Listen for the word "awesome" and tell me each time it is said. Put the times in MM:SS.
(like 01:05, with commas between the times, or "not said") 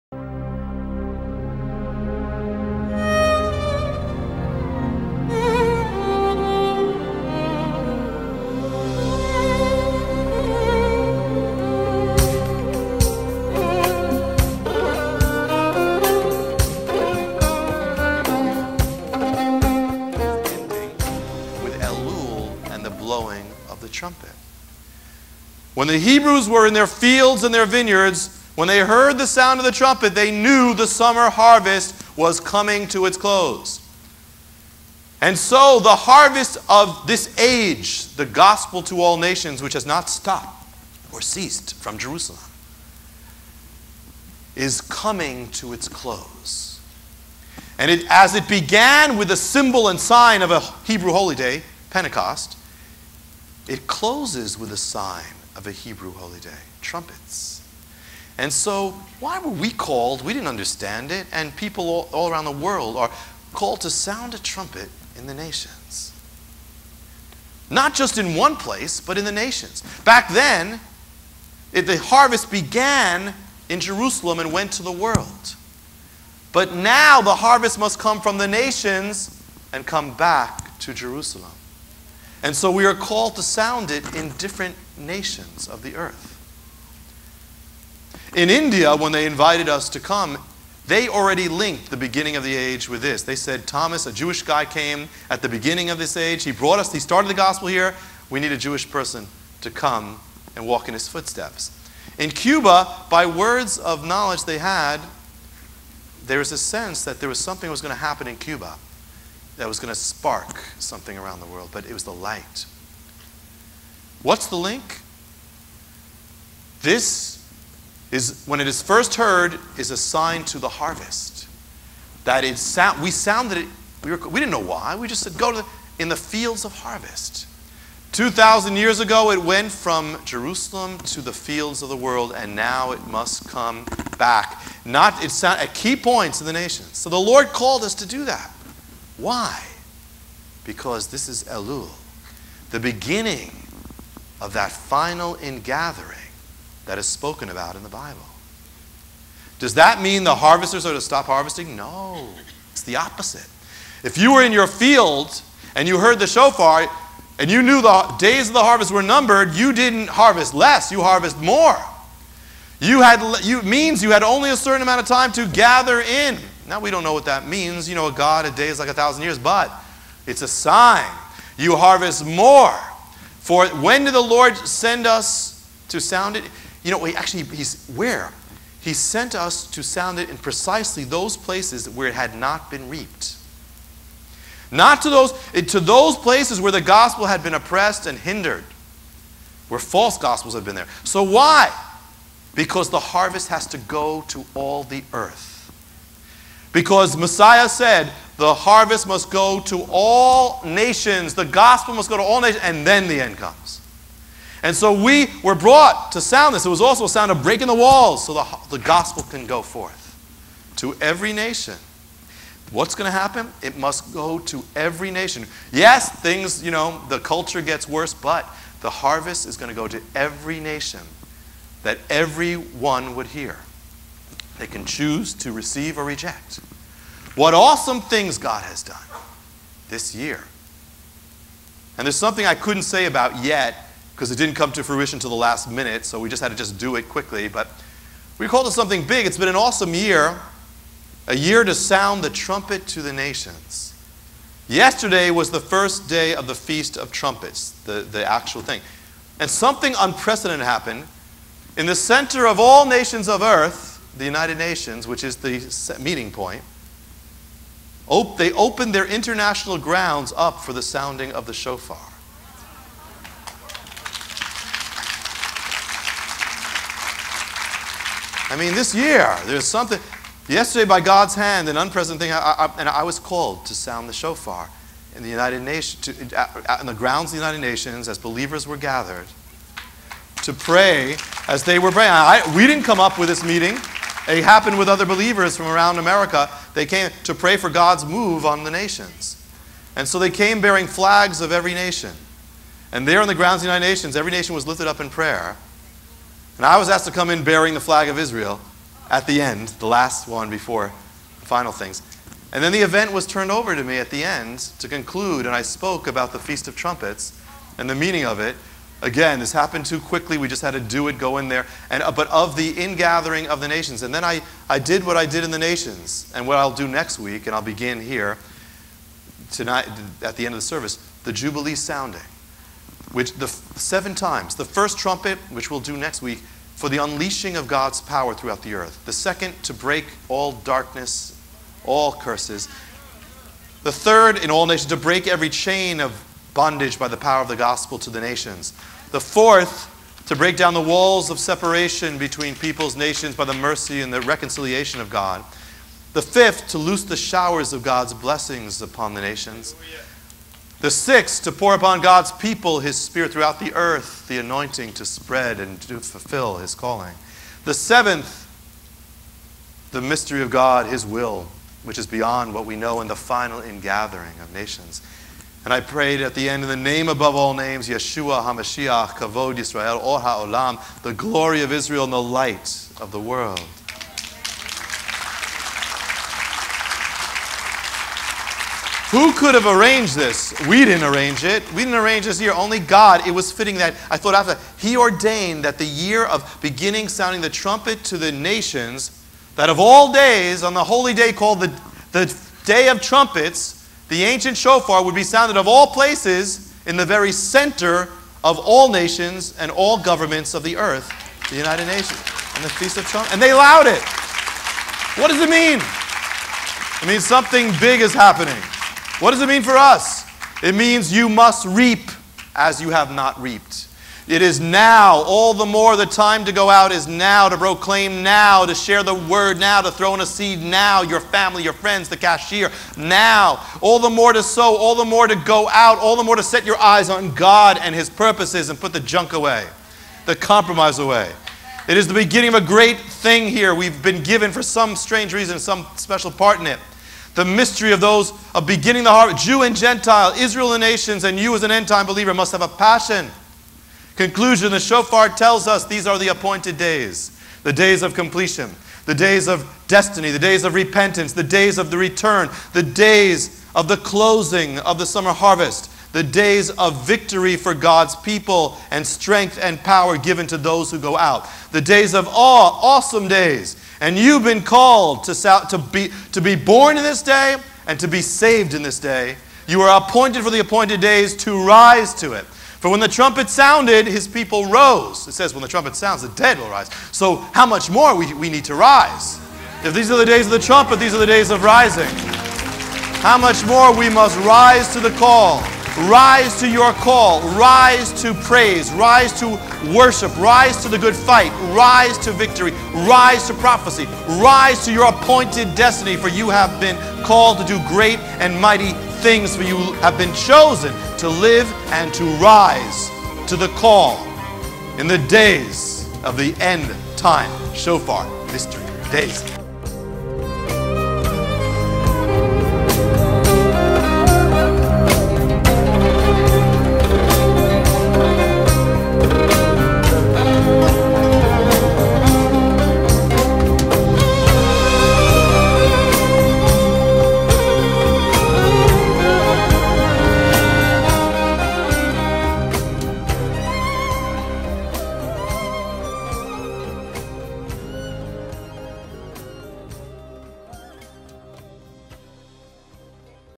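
03:47, 03:59, 07:42.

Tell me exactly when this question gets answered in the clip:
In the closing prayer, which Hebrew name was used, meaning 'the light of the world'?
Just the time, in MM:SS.
06:10.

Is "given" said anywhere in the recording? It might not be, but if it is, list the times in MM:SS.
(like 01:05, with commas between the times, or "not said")
07:14, 07:40.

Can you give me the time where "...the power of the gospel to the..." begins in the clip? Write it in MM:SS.
05:37.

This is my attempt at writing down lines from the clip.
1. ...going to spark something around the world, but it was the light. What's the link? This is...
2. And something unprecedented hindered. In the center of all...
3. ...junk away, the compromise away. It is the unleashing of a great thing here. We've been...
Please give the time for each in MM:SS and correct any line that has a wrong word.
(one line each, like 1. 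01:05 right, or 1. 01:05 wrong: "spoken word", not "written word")
1. 01:49 right
2. 04:09 wrong: "happened", not "hindered"
3. 07:08 wrong: "beginning", not "unleashing".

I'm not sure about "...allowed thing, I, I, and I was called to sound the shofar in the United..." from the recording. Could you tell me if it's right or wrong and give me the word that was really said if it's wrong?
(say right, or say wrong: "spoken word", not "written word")
wrong: "unprecedented", not "allowed".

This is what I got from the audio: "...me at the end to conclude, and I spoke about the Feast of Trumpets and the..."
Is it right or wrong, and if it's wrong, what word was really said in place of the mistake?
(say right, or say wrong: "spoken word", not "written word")
right.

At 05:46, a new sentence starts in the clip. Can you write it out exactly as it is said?
The fifth, to loose the showers of God's blessings upon the nations.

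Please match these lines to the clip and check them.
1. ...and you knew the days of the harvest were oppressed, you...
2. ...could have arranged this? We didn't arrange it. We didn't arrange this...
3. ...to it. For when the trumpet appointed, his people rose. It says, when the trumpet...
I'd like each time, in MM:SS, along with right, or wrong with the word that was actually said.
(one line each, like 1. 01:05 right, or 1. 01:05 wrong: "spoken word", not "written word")
1. 02:37 wrong: "numbered", not "oppressed"
2. 06:19 right
3. 07:52 wrong: "sounded", not "appointed".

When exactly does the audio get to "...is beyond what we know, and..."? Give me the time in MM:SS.
06:01.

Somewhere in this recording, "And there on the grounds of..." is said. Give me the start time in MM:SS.
04:52.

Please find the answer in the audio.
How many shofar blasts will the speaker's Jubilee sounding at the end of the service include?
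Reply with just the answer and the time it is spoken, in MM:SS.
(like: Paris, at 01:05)
7, at 05:23.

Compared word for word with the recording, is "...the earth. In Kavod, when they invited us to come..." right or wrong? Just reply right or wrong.
wrong.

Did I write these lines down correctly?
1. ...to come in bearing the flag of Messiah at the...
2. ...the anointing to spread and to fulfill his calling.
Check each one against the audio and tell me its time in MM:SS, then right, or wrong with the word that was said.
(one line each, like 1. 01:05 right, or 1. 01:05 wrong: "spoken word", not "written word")
1. 04:57 wrong: "Israel", not "Messiah"
2. 05:54 right.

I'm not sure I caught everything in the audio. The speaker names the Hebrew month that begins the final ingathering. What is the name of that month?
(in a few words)
Elul.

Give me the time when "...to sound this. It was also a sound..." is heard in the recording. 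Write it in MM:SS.
03:26.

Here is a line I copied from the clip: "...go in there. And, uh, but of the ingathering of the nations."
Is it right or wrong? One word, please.
right.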